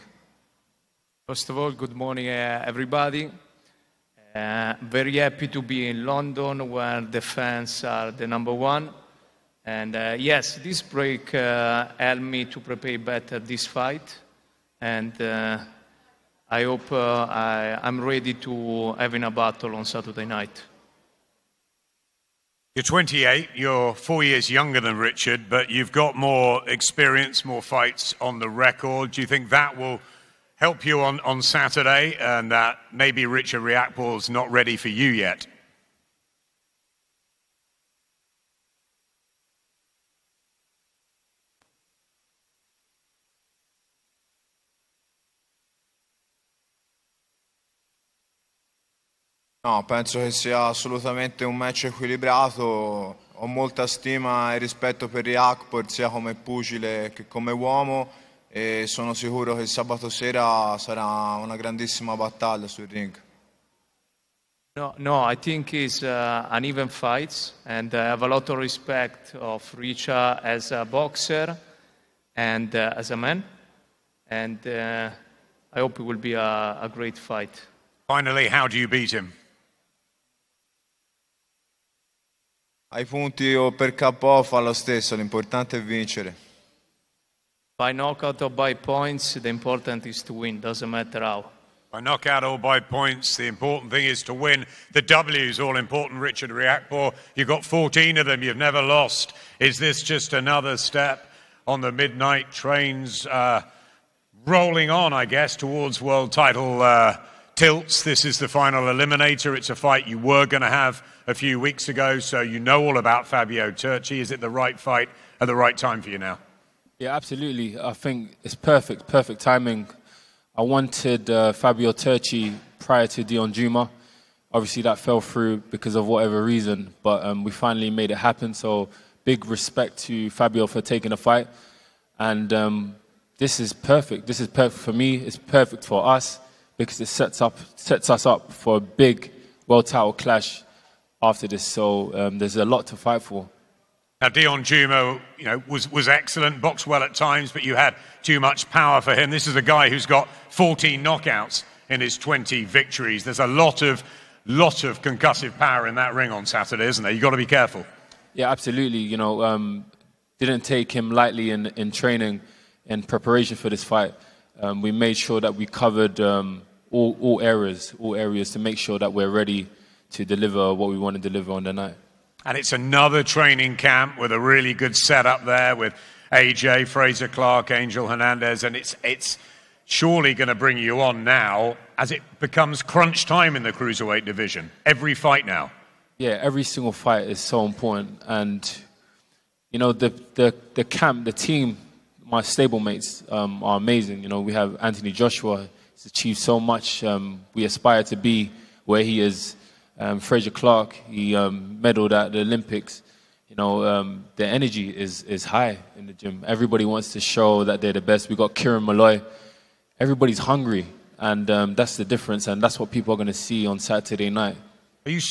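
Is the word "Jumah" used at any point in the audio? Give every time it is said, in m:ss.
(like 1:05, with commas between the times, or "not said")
2:03, 2:24.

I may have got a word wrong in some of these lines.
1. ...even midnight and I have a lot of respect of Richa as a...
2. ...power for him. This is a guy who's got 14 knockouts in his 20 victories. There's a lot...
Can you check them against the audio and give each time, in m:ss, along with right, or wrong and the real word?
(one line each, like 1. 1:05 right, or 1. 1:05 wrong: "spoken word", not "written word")
1. 1:06 wrong: "fight", not "midnight"
2. 2:28 right.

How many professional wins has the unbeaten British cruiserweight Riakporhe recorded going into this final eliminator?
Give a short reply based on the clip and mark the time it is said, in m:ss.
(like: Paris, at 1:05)
14, at 1:37.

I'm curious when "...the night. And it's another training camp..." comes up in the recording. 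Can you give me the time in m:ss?
2:51.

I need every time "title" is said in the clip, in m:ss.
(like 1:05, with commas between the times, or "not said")
1:46, 2:19.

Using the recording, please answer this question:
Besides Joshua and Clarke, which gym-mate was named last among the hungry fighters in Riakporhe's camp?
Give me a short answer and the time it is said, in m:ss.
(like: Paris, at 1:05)
Kieran Malloy, at 3:28.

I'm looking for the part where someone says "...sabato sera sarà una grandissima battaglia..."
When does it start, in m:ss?
0:59.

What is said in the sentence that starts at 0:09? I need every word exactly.
And uh, yes, this break uh, helped me to prepare better this fight.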